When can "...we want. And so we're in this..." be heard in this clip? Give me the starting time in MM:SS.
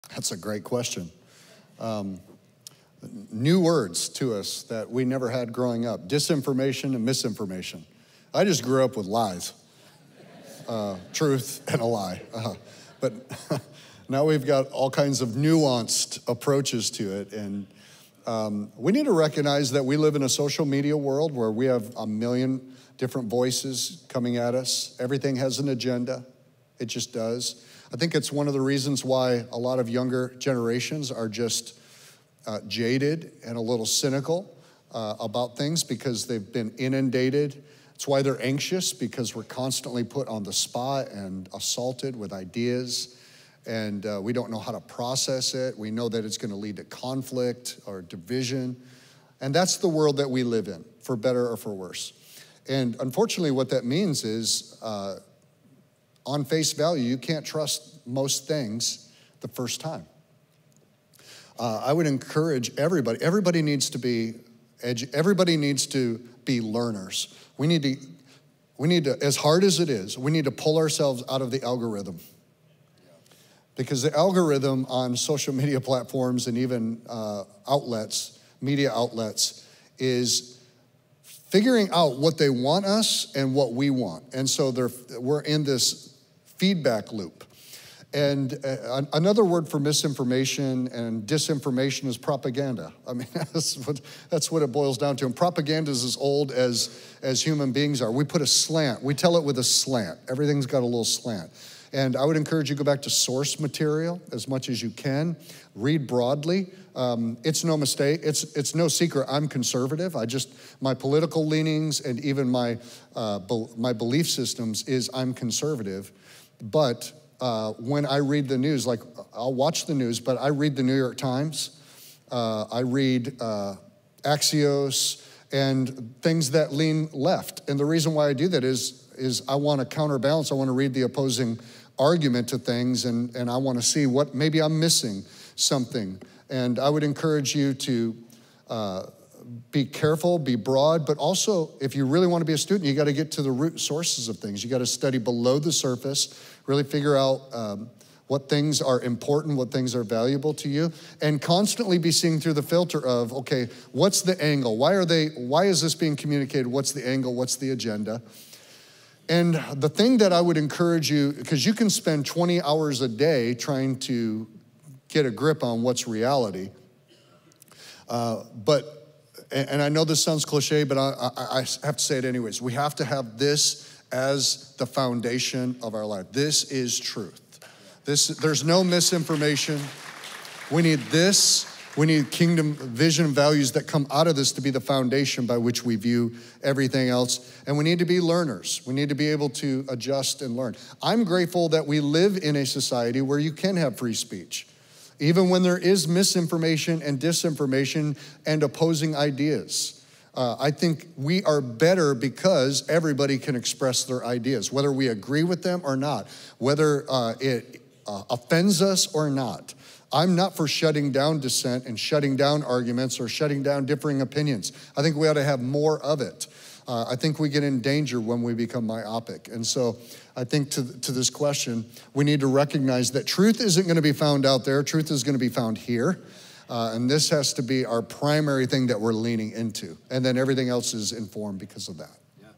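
01:23.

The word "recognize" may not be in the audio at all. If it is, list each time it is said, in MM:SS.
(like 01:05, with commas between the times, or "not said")
00:19, 03:42.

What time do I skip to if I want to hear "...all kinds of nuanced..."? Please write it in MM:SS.
00:14.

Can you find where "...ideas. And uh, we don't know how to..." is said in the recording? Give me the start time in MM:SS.
00:42.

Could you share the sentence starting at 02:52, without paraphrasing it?
We have to have this as the foundation of our life.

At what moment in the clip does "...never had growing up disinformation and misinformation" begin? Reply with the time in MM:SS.
00:05.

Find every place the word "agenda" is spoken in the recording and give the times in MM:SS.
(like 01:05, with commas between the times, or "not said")
00:25, 02:37.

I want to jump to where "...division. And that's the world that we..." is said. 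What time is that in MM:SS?
00:48.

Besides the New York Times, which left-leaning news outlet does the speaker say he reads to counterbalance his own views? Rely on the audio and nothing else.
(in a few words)
Axios.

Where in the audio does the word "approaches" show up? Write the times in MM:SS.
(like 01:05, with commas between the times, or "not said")
00:16.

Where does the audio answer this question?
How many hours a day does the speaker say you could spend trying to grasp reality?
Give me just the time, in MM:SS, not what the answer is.
02:42.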